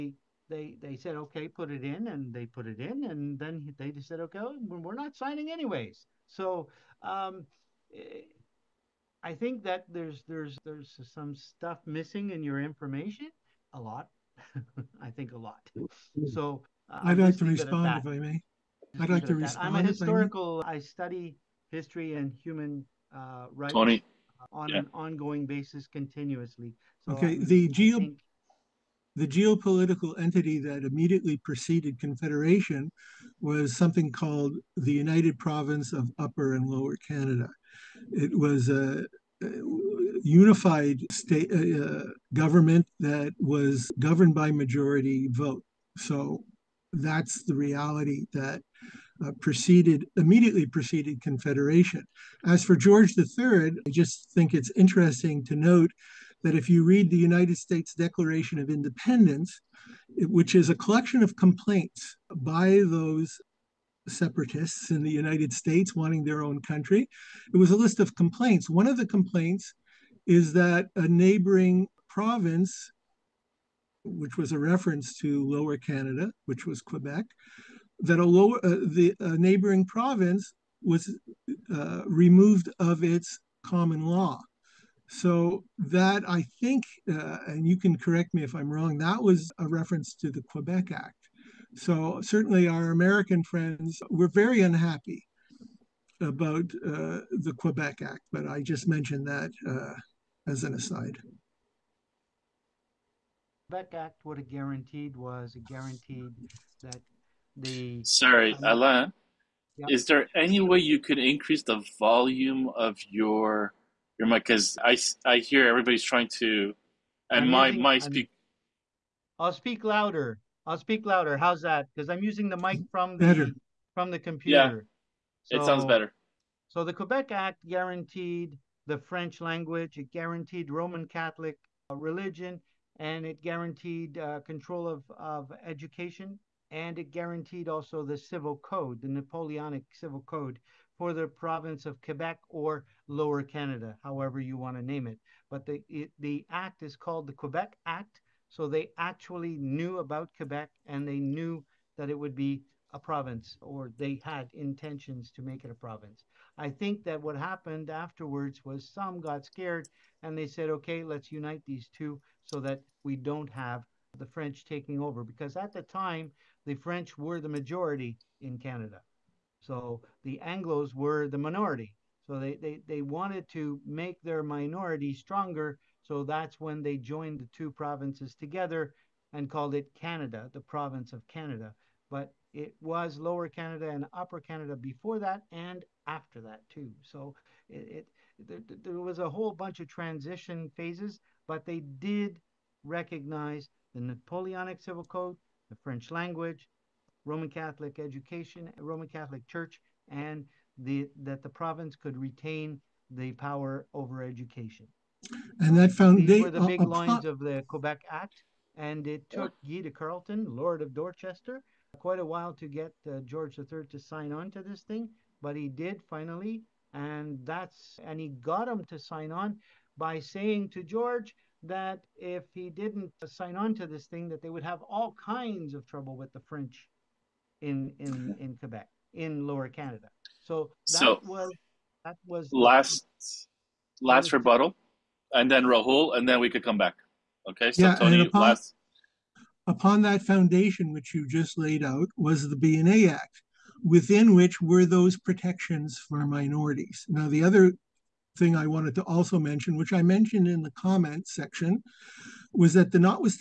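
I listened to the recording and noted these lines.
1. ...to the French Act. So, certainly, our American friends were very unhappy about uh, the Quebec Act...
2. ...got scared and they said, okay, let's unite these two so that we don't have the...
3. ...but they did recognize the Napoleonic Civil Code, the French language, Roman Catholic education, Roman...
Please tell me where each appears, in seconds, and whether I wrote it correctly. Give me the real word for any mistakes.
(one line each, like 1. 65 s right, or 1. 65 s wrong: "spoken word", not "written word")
1. 90 s wrong: "Quebec", not "French"
2. 159 s right
3. 191 s right.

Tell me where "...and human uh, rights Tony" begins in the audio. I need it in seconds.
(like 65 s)
22 s.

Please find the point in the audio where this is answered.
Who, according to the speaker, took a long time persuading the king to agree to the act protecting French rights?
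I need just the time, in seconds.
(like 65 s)
209 s.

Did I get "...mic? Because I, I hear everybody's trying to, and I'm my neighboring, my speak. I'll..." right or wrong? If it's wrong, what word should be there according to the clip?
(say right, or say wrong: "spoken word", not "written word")
wrong: "using", not "neighboring".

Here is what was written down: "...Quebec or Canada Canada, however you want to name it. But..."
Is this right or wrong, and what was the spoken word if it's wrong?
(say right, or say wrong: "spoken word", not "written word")
wrong: "Lower", not "Canada".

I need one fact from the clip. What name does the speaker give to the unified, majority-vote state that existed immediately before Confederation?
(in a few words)
United Province of Upper and Lower Canada.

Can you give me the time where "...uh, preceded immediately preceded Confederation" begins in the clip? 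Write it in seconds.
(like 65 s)
49 s.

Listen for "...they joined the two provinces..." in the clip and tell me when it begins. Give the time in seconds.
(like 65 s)
176 s.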